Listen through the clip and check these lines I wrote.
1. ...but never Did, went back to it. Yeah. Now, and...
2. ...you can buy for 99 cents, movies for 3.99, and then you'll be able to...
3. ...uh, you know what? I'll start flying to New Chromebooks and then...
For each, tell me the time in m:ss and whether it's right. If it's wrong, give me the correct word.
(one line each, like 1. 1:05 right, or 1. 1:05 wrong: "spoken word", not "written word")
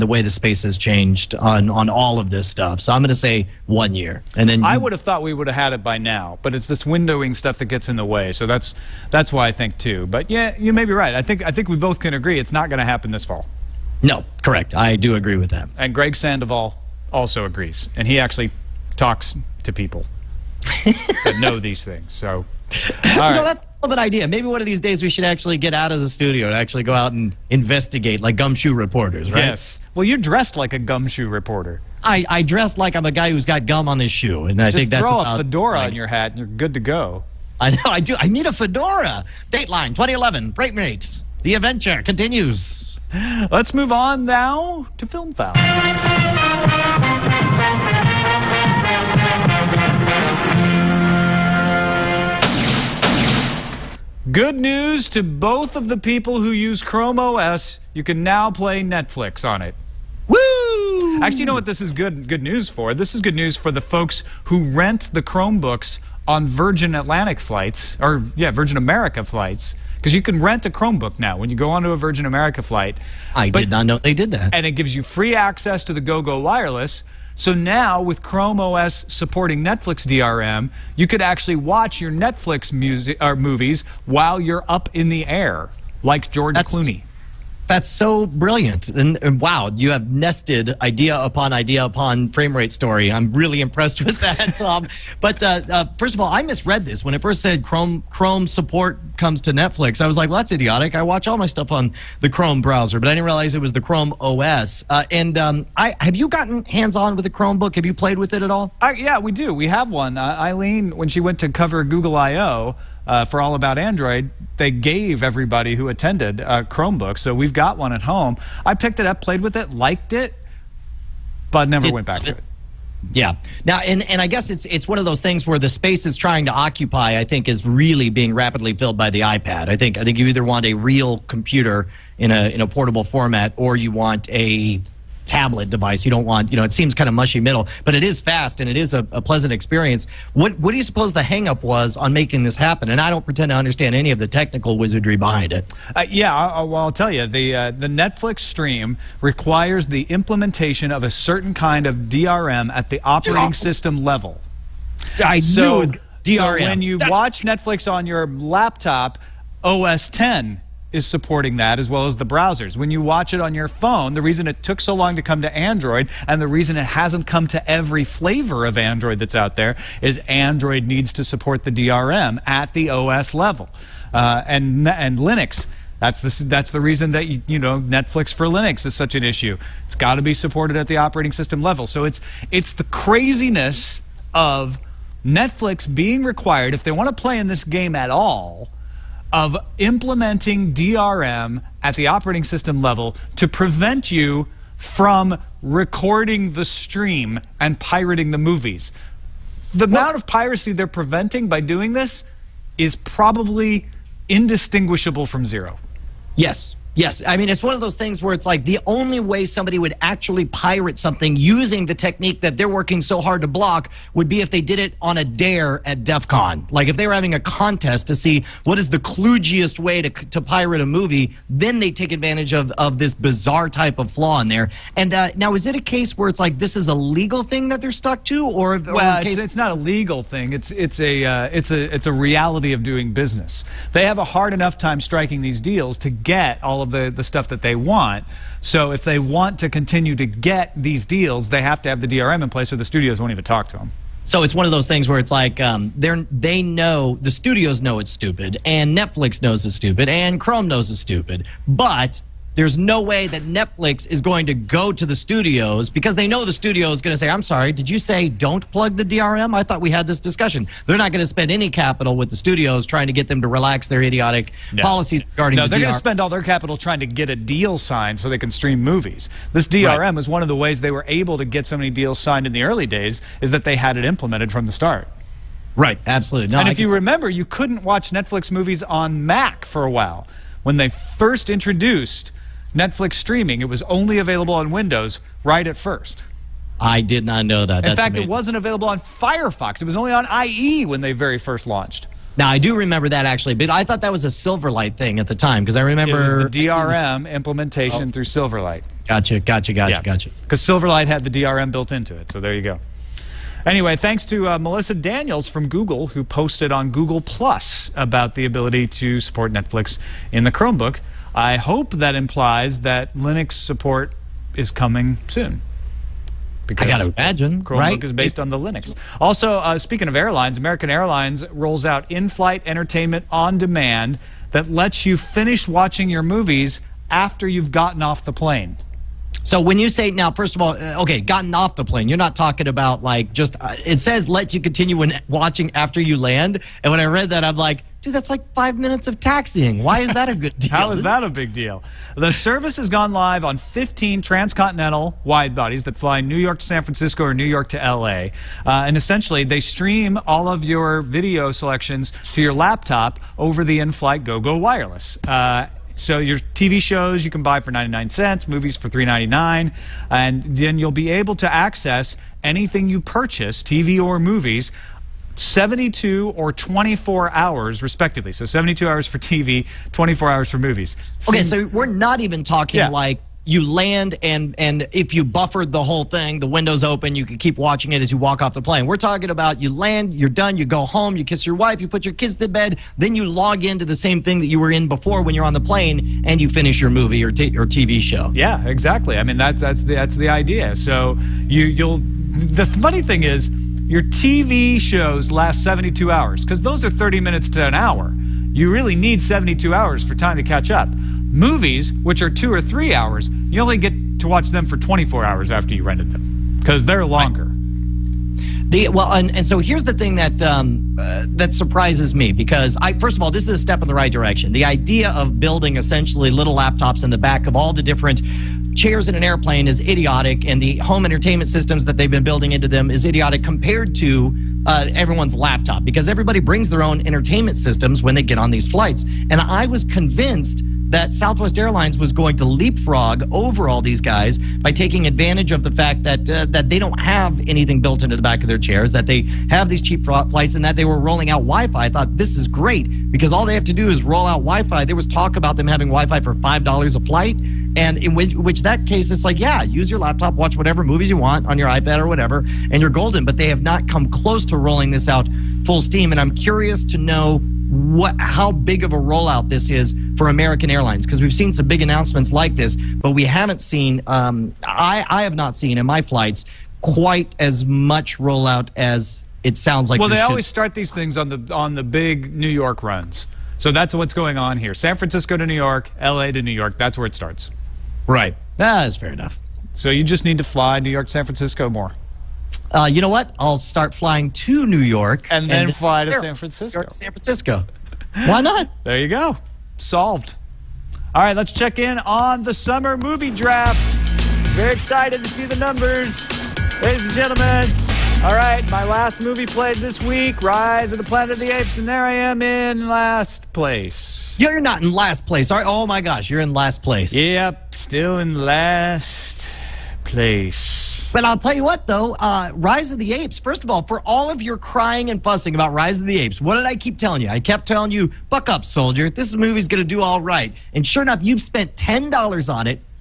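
1. 2:01 right
2. 5:57 right
3. 8:02 wrong: "York", not "Chromebooks".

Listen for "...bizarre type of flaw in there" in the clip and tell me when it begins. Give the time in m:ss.
3:43.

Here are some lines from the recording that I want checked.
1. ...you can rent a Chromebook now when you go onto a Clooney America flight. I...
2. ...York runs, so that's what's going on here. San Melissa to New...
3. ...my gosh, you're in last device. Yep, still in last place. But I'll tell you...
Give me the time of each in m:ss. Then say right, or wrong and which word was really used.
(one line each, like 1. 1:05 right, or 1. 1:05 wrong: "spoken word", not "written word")
1. 1:10 wrong: "Virgin", not "Clooney"
2. 7:52 wrong: "Francisco", not "Melissa"
3. 8:25 wrong: "place", not "device".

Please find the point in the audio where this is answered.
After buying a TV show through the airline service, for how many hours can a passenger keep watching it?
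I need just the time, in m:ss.
6:08.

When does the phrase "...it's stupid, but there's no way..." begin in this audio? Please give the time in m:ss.
4:10.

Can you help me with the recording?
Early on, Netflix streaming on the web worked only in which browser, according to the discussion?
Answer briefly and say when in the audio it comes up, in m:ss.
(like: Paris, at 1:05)
IE, at 4:50.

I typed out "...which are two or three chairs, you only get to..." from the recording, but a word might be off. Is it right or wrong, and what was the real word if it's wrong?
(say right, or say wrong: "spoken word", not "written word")
wrong: "hours", not "chairs".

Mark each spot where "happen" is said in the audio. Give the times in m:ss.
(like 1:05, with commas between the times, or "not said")
0:12, 2:22.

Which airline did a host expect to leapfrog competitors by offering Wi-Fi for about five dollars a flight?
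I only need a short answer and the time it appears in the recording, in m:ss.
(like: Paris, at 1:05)
Southwest Airlines, at 7:11.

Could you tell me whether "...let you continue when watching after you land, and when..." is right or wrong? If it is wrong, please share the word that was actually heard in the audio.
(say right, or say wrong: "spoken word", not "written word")
right.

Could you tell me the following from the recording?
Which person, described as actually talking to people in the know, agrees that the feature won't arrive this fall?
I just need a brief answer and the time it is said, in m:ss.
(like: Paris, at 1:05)
Greg Sandoval, at 0:15.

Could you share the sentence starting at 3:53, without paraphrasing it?
They have a hard enough time striking these deals to get all of of the, the stuff that they want.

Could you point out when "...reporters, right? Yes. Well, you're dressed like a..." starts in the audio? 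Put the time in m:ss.
0:28.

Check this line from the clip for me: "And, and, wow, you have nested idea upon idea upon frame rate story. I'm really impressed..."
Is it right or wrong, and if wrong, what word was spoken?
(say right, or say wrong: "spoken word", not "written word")
right.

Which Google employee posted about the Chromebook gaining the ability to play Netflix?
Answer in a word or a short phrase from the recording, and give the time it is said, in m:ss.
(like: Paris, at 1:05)
Melissa Daniels, at 5:04.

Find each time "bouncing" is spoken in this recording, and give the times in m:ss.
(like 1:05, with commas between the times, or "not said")
not said.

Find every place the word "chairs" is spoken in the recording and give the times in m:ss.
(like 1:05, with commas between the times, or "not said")
6:58, 7:18.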